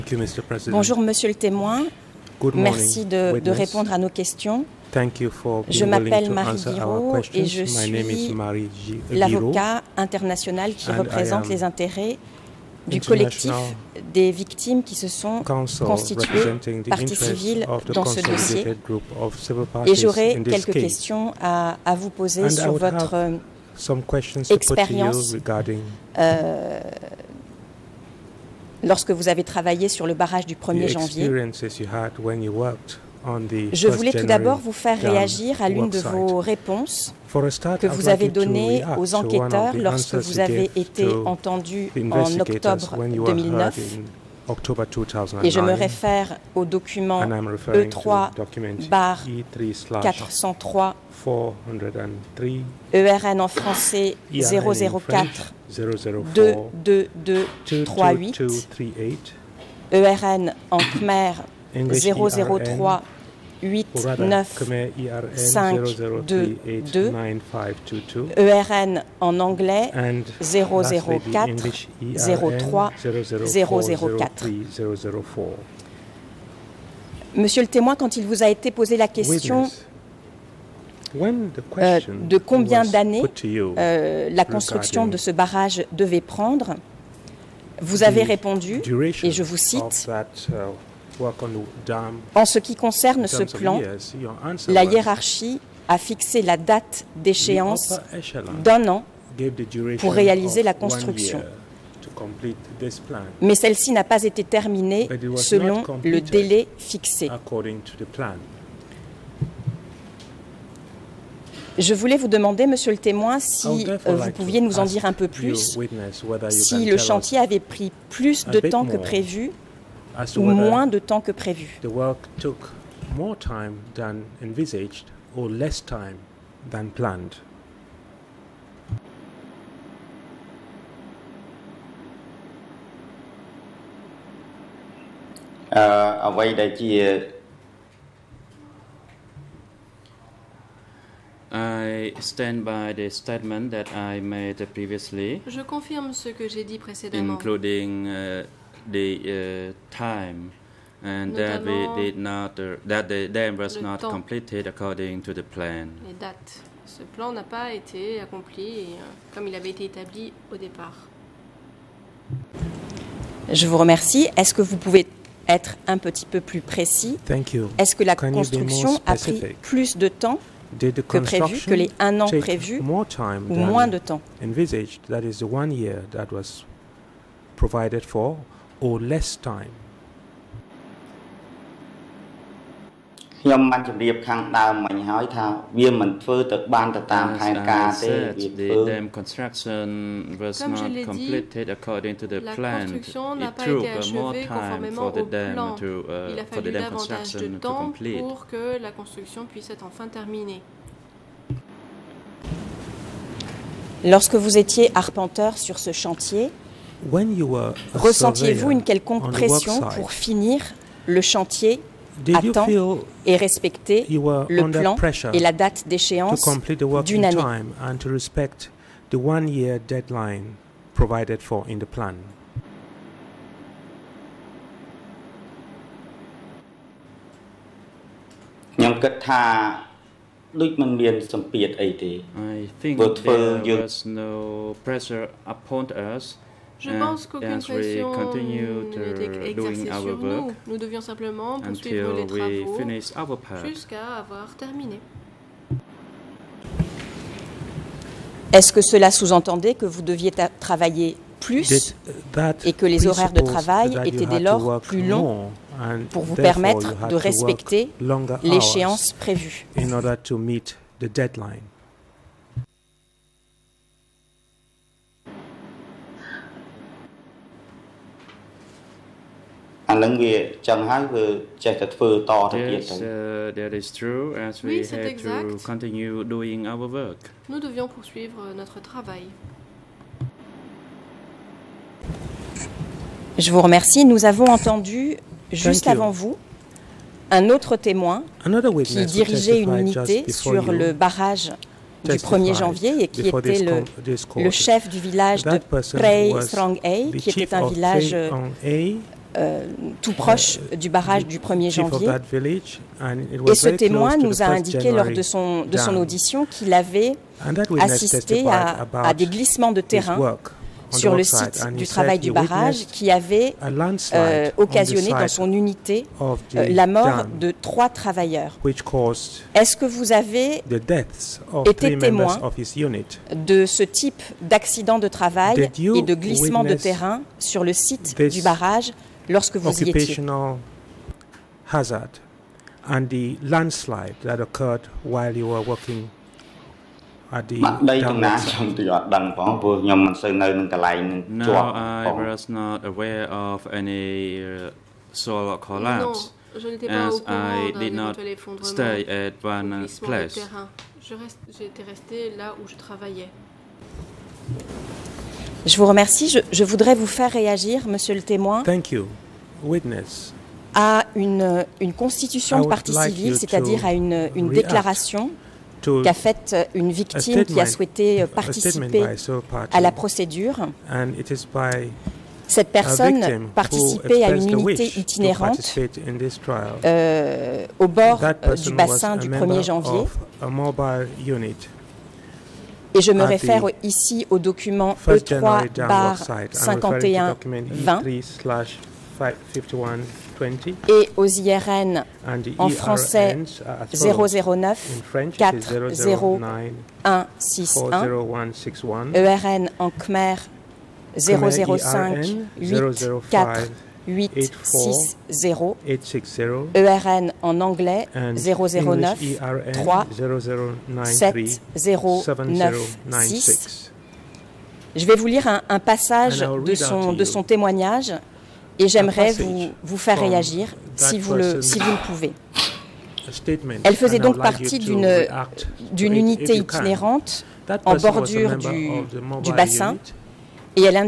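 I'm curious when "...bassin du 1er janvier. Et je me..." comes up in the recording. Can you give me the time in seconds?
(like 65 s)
378 s.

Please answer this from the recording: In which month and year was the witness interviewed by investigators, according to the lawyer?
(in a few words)
October 2009.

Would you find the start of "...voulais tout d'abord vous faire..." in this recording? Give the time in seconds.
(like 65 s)
33 s.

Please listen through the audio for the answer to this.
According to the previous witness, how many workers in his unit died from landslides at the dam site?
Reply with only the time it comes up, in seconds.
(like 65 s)
317 s.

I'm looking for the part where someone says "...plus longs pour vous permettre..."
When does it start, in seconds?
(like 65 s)
254 s.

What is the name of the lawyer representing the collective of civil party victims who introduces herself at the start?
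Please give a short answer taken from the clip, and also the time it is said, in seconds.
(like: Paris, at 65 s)
Marie Giraud, at 6 s.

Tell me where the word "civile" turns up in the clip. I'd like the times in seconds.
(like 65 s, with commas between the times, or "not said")
17 s, 362 s.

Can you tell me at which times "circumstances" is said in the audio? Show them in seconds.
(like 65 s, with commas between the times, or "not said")
not said.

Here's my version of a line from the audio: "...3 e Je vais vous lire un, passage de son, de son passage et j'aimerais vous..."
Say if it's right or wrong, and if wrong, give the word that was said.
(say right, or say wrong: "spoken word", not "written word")
wrong: "témoignage", not "passage".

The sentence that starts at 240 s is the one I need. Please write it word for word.
Nous devions simplement poursuivre les travaux jusqu'à avoir terminé.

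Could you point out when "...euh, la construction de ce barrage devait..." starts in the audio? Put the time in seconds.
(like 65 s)
83 s.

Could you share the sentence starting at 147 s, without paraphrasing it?
Including uh, the uh, time and we did not uh, that the dam was not temps.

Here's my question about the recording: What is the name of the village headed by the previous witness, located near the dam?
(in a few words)
Prey Strong A.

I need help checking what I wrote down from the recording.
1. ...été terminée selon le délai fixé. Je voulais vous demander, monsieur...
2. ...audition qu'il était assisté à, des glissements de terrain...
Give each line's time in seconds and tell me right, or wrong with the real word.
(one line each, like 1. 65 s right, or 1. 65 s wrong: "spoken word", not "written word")
1. 104 s right
2. 305 s wrong: "avait", not "était".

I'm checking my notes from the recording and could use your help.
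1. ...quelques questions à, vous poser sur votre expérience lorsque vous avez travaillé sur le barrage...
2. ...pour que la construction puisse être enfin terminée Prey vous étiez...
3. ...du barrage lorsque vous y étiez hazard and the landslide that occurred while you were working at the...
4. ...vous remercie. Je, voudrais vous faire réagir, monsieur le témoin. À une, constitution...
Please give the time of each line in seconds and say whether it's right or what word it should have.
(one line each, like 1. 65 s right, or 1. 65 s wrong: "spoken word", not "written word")
1. 20 s right
2. 198 s wrong: "Lorsque", not "Prey"
3. 328 s right
4. 355 s right.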